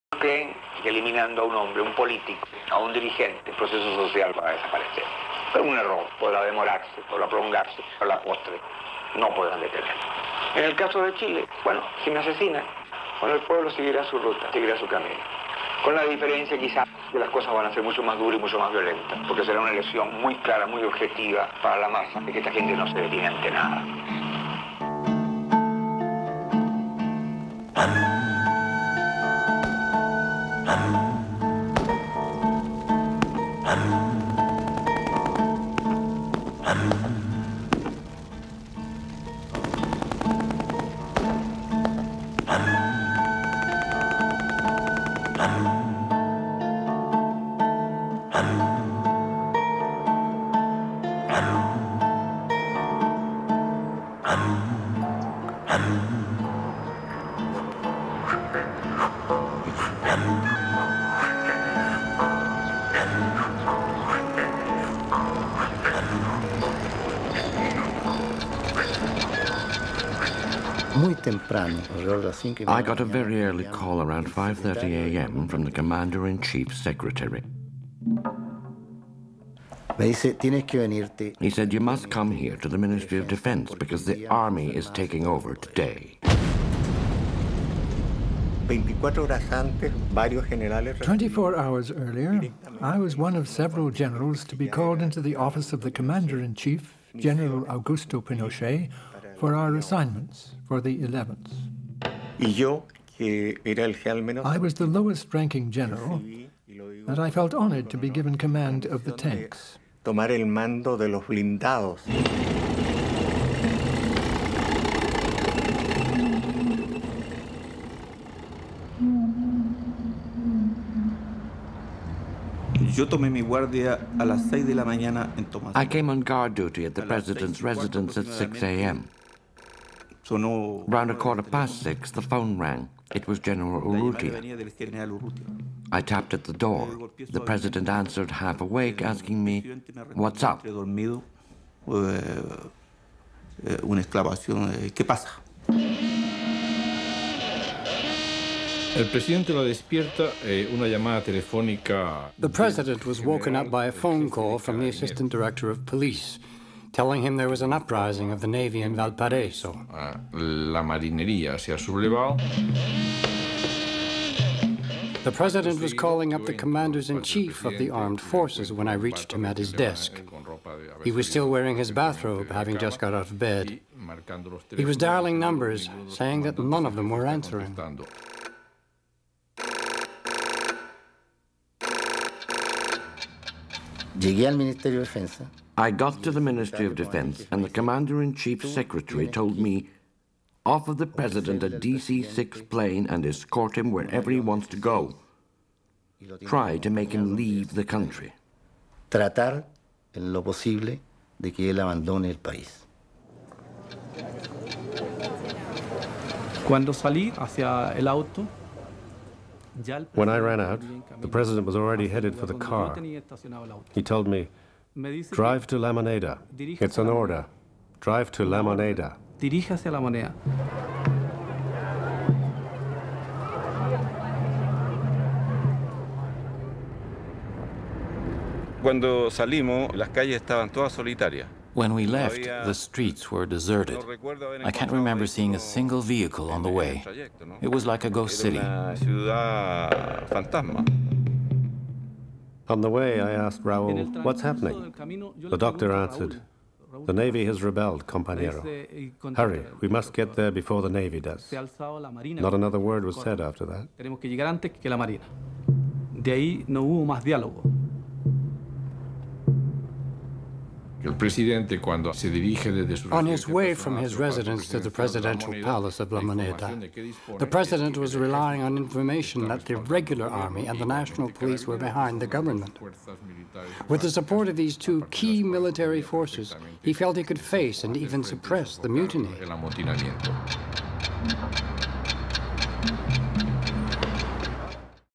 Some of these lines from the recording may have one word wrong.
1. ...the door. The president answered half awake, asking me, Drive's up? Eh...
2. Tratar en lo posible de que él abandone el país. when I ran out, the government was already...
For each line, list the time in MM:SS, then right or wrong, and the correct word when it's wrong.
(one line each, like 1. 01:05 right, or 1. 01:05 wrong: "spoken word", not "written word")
1. 02:16 wrong: "What", not "Drive"
2. 03:19 wrong: "president", not "government".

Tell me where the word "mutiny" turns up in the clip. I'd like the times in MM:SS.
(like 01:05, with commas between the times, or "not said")
04:38.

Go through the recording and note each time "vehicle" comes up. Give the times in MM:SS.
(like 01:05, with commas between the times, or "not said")
03:56.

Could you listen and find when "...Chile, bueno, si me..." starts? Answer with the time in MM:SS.
00:11.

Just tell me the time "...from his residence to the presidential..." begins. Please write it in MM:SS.
04:23.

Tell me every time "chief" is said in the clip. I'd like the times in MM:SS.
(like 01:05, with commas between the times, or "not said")
01:15, 01:36, 02:47, 03:08.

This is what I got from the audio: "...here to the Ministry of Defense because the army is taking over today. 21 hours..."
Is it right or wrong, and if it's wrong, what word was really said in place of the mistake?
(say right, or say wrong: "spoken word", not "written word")
wrong: "24", not "21".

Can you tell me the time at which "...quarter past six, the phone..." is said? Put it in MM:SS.
02:11.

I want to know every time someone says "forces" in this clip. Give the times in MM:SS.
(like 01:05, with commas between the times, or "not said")
02:48, 04:36.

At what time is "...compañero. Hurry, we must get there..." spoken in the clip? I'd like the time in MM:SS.
04:08.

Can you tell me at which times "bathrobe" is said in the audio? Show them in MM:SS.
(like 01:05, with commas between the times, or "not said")
02:51.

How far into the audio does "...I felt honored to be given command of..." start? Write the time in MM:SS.
01:47.